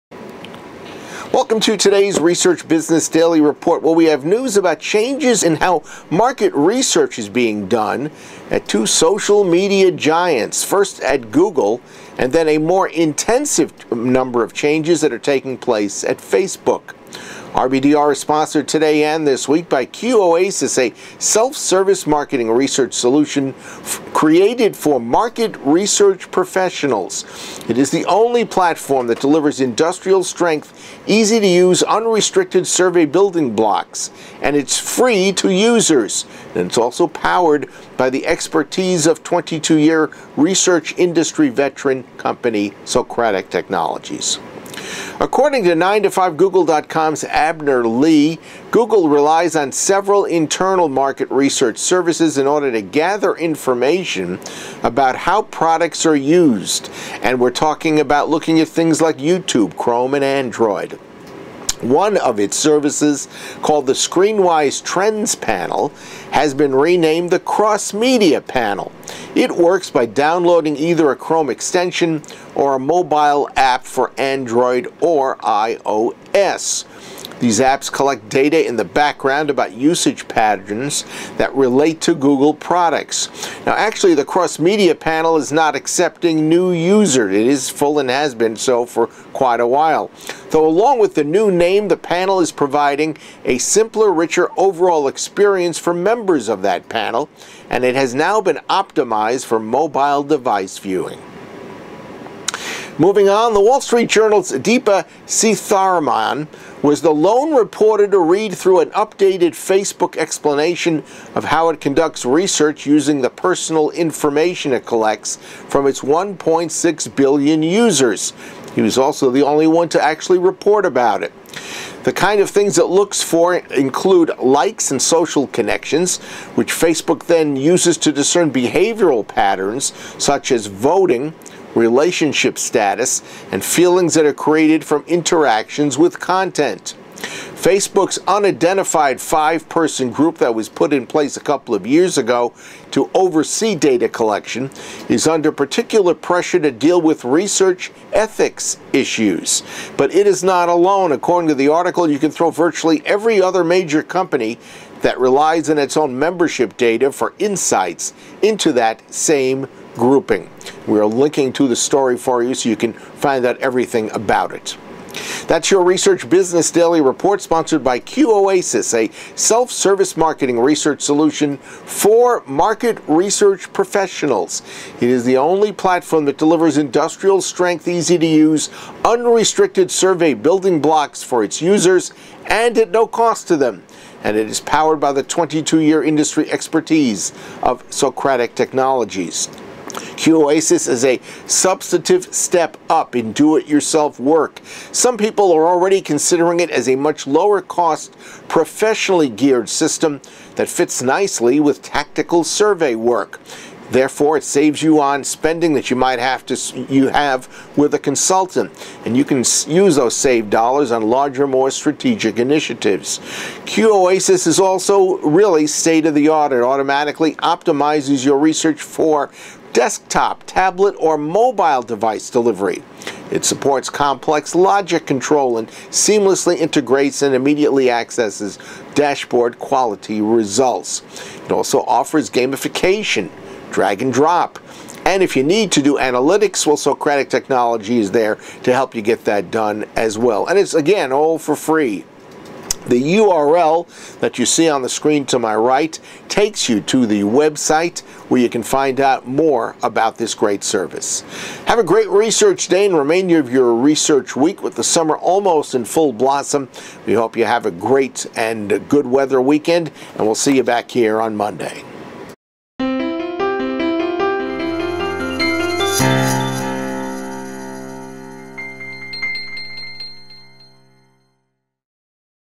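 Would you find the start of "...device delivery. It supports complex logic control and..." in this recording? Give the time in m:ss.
3:41.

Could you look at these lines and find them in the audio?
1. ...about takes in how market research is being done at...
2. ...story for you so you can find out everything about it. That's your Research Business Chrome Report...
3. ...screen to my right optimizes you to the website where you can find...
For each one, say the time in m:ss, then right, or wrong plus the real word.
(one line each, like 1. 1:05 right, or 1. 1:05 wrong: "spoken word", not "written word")
1. 0:04 wrong: "changes", not "takes"
2. 2:41 wrong: "Daily", not "Chrome"
3. 4:04 wrong: "takes", not "optimizes".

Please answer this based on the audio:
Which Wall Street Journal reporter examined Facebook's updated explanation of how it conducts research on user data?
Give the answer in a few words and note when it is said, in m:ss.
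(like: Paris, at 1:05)
Deepa Seetharaman, at 1:44.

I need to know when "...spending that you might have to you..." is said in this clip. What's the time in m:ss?
3:25.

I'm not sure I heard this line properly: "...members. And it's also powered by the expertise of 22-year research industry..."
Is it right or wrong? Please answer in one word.
wrong.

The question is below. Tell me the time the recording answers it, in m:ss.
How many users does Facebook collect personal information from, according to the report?
1:56.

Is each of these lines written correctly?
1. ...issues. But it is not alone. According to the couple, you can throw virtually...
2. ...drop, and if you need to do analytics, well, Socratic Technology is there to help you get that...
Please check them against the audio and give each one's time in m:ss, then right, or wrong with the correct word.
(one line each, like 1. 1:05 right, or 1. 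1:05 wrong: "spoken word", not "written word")
1. 2:28 wrong: "article", not "couple"
2. 3:54 right.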